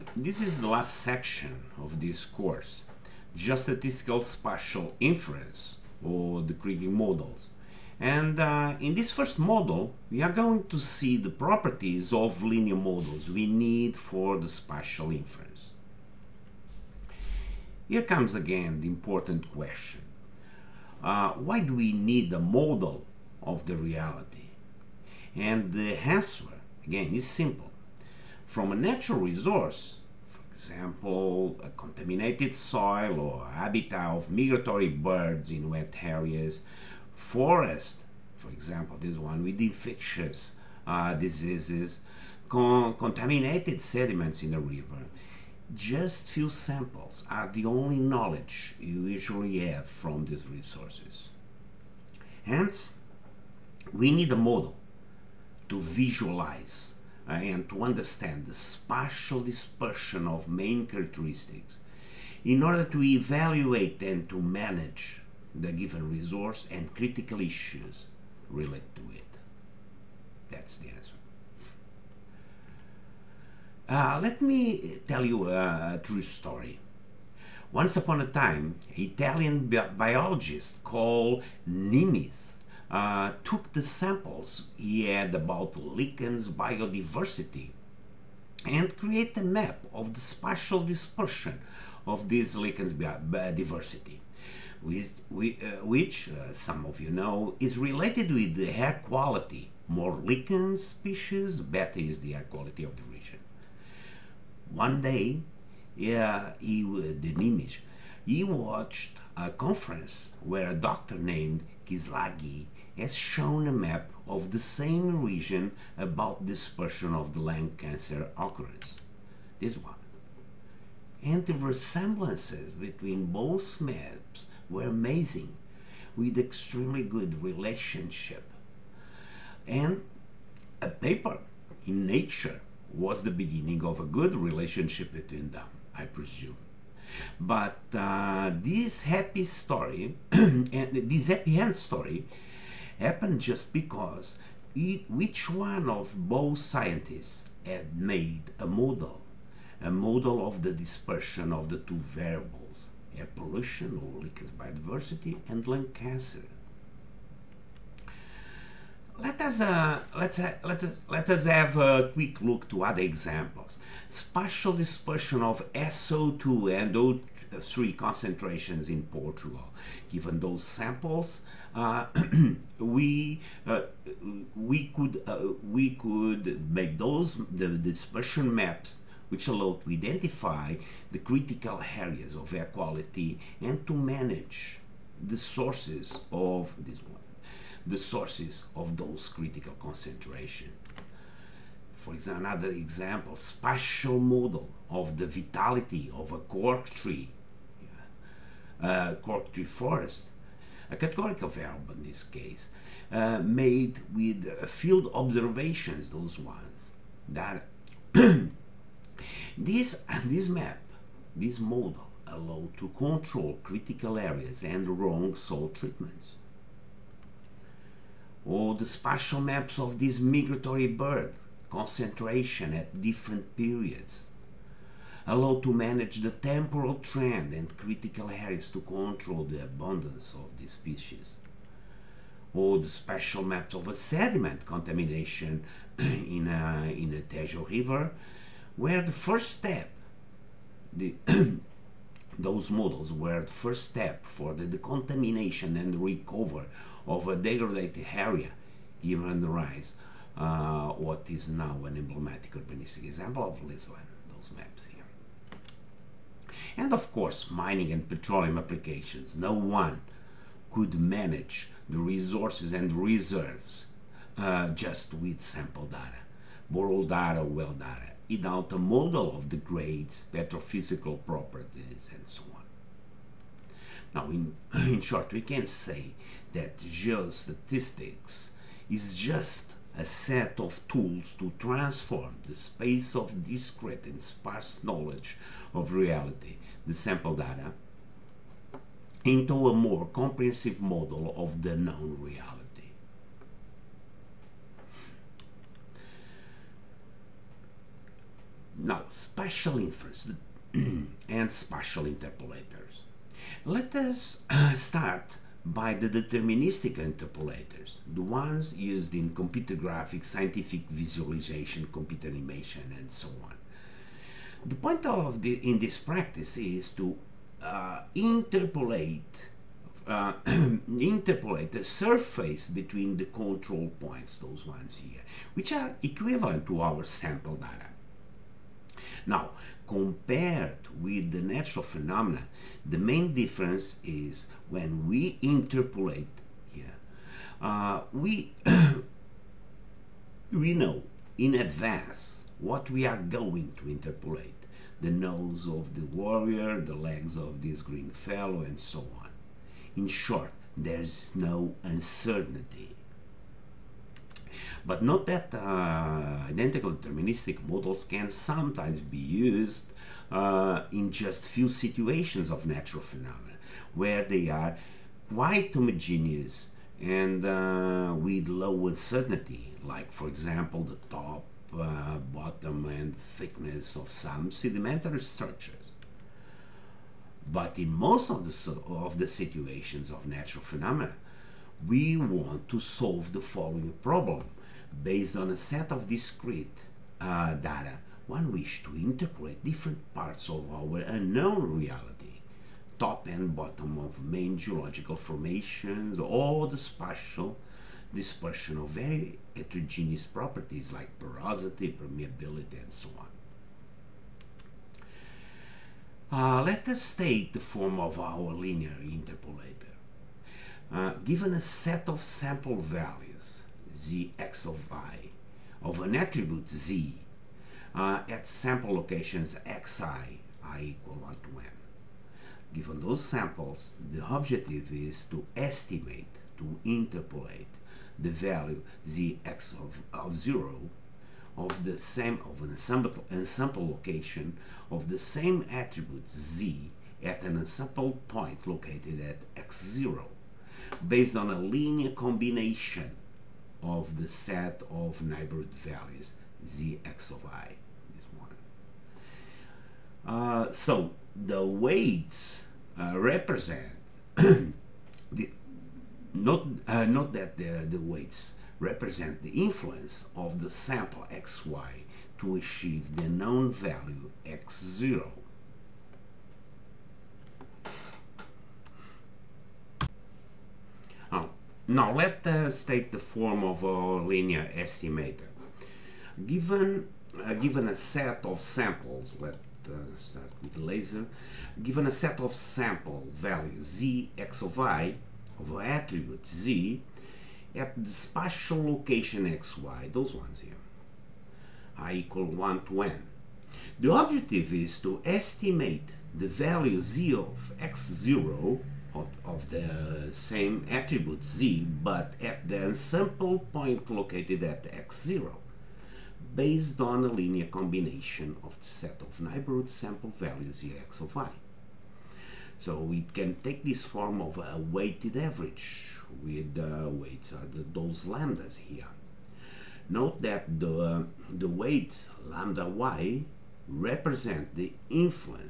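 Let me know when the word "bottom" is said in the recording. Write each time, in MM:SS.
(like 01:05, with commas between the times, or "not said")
06:12, 06:33.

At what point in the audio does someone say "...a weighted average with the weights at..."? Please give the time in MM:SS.
08:34.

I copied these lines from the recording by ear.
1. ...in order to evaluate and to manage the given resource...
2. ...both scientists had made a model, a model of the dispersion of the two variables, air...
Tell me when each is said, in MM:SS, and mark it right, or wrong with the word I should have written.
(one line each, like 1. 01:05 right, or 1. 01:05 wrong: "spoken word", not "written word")
1. 01:02 right
2. 02:26 right.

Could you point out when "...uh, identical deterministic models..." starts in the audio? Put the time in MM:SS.
05:55.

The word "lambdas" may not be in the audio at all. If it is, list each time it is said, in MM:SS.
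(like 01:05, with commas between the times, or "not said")
08:38, 08:42.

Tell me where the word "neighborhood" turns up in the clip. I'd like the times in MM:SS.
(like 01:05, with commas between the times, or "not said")
07:25, 08:29.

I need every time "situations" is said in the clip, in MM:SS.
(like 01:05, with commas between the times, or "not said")
06:01, 06:19.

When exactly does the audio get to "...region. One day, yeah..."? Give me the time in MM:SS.
01:43.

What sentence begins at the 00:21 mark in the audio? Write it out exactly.
Uh, why do we need a model of the reality?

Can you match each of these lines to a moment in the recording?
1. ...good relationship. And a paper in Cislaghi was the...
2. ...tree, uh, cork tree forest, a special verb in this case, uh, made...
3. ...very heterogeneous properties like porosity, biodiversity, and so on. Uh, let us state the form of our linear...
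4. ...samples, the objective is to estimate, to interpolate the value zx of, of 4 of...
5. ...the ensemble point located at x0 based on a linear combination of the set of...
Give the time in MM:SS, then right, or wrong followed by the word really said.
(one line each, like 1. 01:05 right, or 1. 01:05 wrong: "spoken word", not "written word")
1. 02:07 wrong: "Nature", not "Cislaghi"
2. 03:16 wrong: "categorical", not "special"
3. 06:38 wrong: "permeability", not "biodiversity"
4. 07:03 wrong: "0", not "4"
5. 08:22 right.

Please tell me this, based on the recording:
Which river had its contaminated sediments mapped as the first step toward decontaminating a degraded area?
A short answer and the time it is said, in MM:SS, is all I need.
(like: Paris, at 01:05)
Tejo River, at 03:57.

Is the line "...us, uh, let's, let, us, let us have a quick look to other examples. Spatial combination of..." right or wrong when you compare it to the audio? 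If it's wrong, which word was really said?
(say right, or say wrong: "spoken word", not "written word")
wrong: "dispersion", not "combination".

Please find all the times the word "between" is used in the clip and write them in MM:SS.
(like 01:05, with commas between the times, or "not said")
02:02, 02:15, 05:22.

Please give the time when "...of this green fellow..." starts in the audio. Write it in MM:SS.
05:47.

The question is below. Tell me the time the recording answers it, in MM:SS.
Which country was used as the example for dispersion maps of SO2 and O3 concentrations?
02:49.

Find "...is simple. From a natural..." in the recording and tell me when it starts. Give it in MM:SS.
00:27.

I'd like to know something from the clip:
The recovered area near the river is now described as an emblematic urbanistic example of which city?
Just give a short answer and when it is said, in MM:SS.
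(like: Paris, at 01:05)
Lisbon, at 04:13.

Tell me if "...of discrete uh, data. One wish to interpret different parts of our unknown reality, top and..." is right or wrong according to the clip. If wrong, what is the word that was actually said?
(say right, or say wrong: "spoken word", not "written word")
right.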